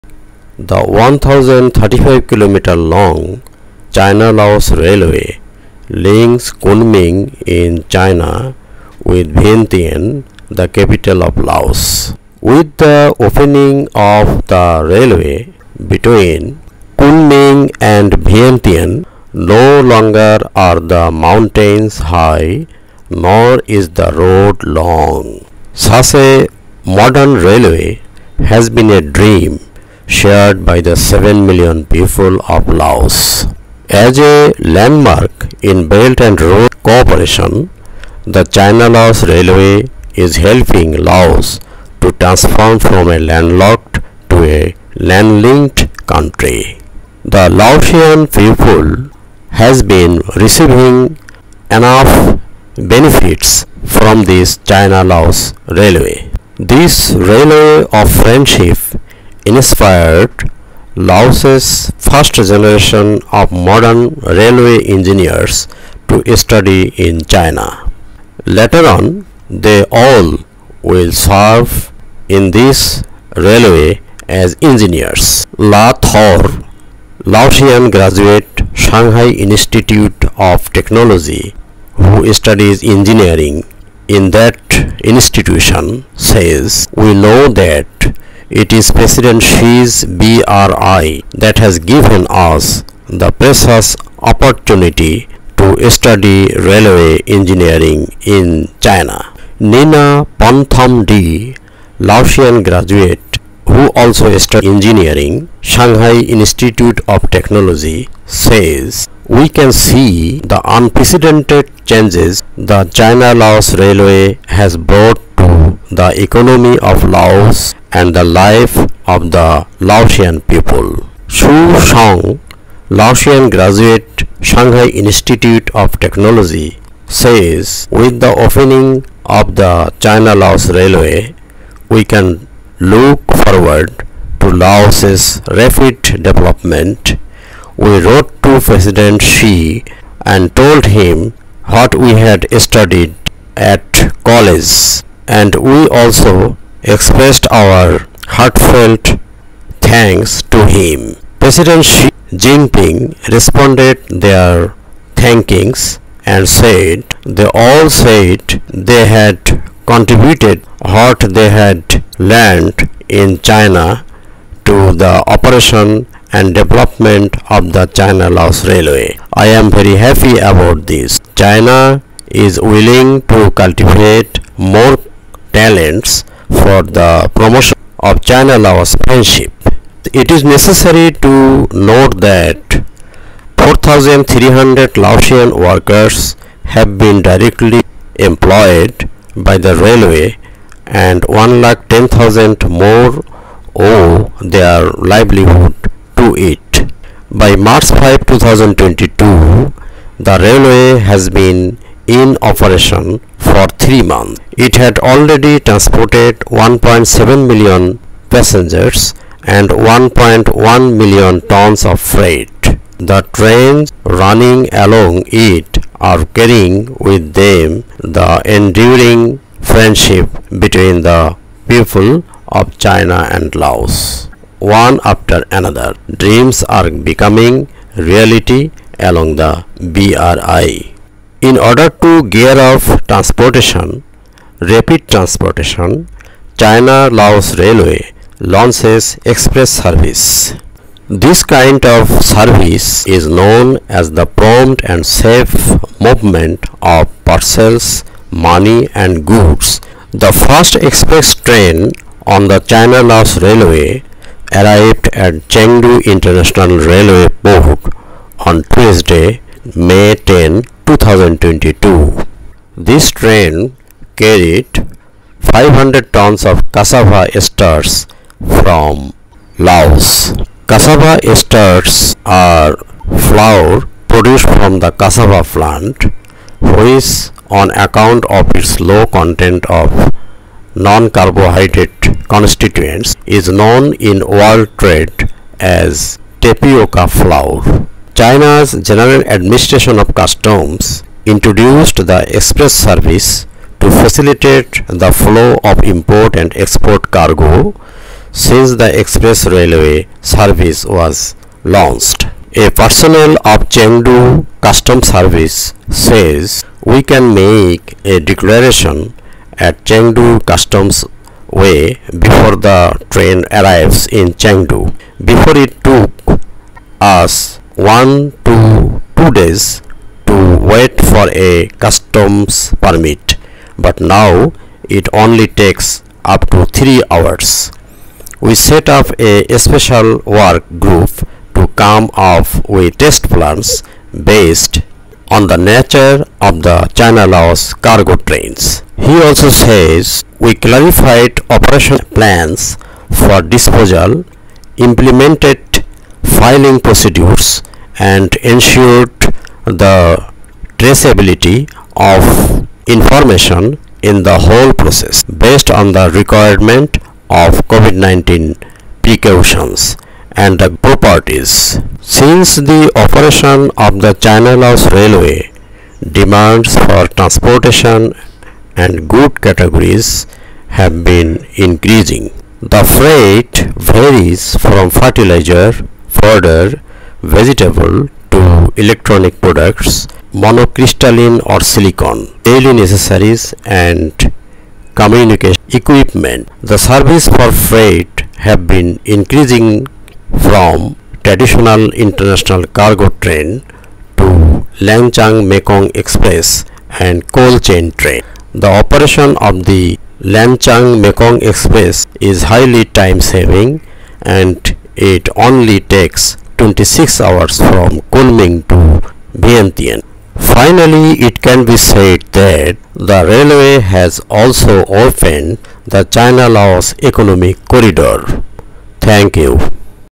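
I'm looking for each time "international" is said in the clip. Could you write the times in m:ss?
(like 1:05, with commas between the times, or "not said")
4:16, 6:31.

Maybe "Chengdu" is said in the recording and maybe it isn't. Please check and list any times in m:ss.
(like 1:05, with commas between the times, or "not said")
4:15, 5:03, 5:09, 5:14.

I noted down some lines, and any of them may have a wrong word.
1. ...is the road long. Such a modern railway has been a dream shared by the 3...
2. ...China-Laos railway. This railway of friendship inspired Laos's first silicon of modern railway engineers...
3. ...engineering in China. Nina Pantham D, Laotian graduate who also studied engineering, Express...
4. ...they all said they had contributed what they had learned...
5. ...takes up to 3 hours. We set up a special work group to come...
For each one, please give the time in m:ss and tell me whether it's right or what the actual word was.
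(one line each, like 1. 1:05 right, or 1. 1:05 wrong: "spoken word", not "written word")
1. 0:23 wrong: "7", not "3"
2. 0:54 wrong: "generation", not "silicon"
3. 1:37 wrong: "Shanghai", not "Express"
4. 2:37 right
5. 5:25 right.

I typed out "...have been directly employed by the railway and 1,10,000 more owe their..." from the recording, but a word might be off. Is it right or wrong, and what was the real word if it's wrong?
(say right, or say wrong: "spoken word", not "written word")
right.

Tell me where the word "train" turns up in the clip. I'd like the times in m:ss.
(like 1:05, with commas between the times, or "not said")
3:33, 4:11, 4:23, 5:13, 5:38, 6:33, 6:37.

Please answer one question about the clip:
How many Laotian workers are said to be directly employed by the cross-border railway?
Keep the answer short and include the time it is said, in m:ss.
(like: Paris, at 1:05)
4,300, at 3:03.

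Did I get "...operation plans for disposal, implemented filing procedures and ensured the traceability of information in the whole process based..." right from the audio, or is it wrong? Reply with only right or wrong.
right.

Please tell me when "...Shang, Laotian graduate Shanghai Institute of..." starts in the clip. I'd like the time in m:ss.
2:01.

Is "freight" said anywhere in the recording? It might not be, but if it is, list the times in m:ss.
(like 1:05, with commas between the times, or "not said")
3:31, 6:12, 6:27.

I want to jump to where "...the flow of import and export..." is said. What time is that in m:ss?
4:54.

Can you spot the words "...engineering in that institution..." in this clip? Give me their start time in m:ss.
1:22.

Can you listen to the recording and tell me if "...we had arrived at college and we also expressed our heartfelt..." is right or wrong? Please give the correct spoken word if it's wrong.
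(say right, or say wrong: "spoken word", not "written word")
wrong: "studied", not "arrived".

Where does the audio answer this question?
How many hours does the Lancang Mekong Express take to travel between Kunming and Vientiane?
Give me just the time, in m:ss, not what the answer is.
6:46.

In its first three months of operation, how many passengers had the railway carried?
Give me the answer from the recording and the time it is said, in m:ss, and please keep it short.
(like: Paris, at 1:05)
1.7 million, at 3:26.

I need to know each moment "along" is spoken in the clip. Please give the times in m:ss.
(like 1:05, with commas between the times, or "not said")
3:34, 3:48.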